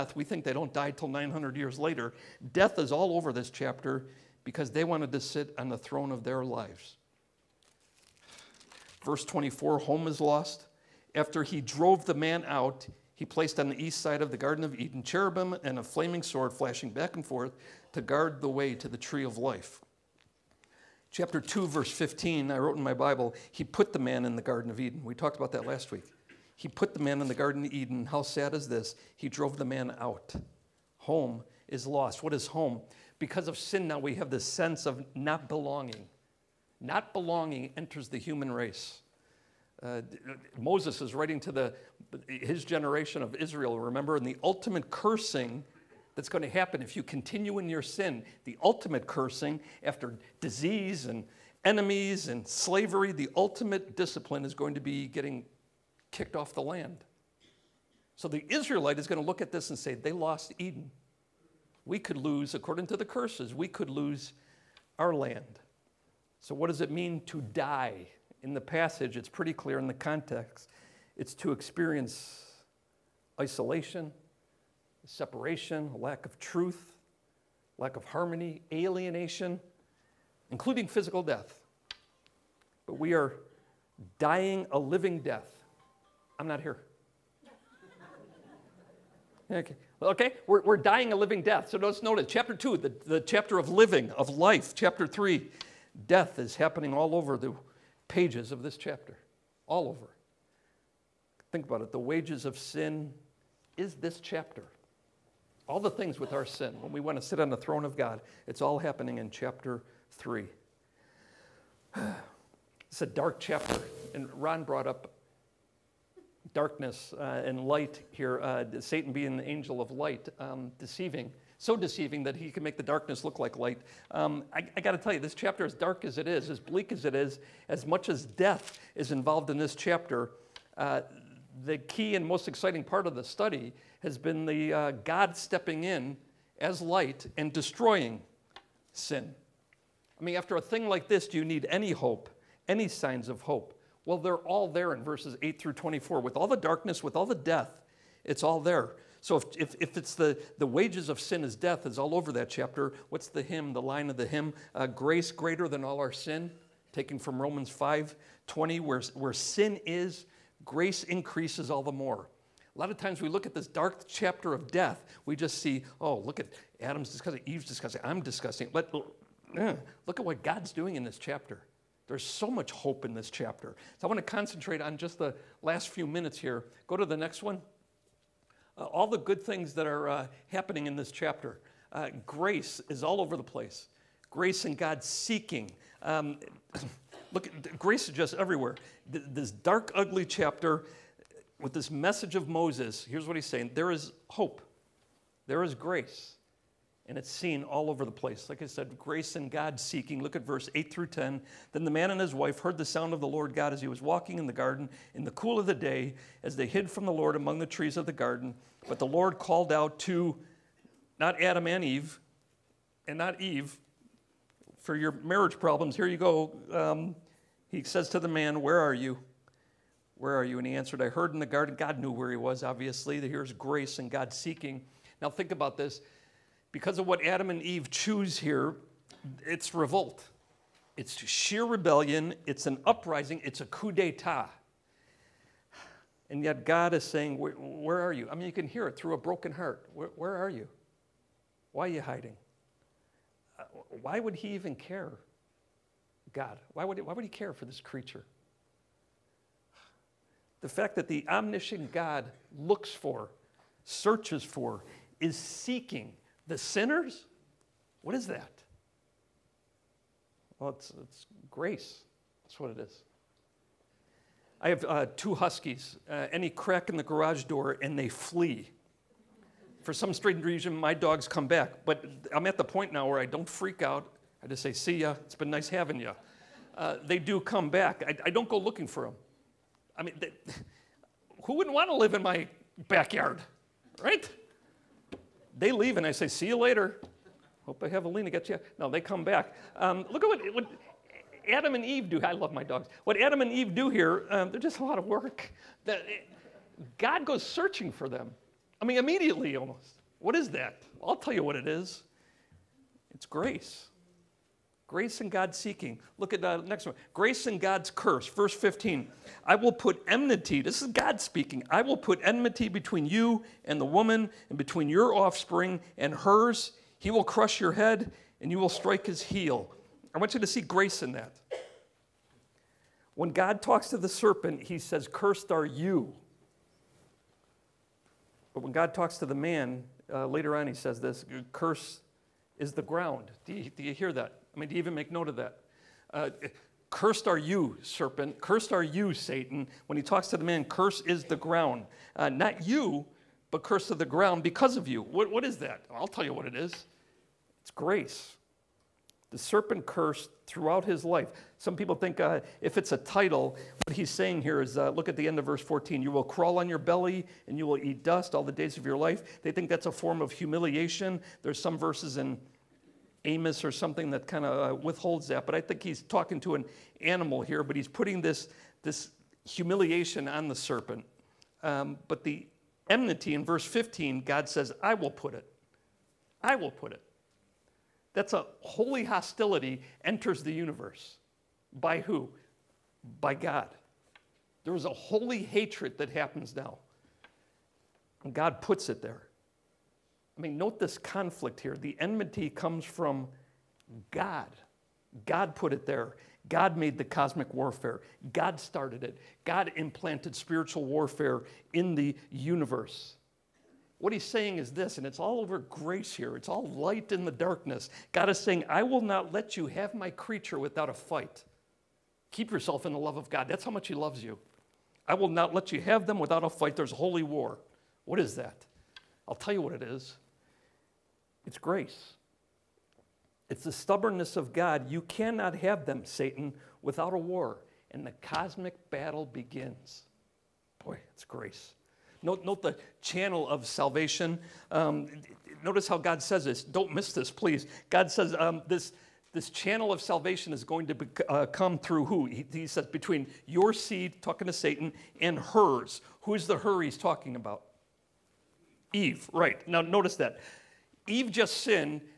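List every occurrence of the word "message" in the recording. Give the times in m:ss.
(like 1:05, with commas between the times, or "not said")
3:11.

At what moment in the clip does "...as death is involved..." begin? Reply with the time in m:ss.
2:08.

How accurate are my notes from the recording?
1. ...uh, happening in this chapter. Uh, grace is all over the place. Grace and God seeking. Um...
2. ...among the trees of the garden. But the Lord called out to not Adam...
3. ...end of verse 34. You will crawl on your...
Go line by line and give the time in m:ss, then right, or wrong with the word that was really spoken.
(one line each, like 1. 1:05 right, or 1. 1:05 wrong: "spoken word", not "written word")
1. 3:00 right
2. 3:27 right
3. 5:55 wrong: "14", not "34".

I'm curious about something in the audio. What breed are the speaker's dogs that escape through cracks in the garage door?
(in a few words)
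Huskies.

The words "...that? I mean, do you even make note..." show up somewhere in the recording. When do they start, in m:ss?
5:34.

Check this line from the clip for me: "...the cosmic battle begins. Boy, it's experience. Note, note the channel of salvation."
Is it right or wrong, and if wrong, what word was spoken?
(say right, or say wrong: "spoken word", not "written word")
wrong: "grace", not "experience".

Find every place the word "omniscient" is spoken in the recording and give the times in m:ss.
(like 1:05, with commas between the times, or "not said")
4:11.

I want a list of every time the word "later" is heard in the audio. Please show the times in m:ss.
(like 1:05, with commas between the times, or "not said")
0:01, 4:46, 5:30.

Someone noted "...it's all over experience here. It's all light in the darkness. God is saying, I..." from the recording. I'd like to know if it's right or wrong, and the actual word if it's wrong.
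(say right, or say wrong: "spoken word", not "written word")
wrong: "grace", not "experience".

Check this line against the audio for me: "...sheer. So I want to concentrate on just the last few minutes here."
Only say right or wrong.
wrong.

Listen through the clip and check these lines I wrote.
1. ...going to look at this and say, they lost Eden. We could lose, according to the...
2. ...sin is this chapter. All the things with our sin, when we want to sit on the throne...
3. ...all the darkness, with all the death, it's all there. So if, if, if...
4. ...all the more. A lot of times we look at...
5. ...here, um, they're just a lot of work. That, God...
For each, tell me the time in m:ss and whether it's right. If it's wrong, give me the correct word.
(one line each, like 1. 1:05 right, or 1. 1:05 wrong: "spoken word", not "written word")
1. 0:59 right
2. 1:42 right
3. 2:26 right
4. 2:41 right
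5. 4:53 right.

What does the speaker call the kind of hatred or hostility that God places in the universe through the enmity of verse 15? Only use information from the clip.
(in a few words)
Holy hostility.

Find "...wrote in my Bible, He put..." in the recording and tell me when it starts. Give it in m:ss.
0:22.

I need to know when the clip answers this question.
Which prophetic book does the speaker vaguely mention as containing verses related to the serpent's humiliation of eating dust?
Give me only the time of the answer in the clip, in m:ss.
6:03.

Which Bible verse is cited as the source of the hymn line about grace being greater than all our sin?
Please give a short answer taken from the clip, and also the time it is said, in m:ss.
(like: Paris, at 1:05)
Romans 5:20, at 2:37.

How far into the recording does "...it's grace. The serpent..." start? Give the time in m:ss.
5:47.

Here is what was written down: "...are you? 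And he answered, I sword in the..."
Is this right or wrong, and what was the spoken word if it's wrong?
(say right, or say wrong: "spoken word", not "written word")
wrong: "heard", not "sword".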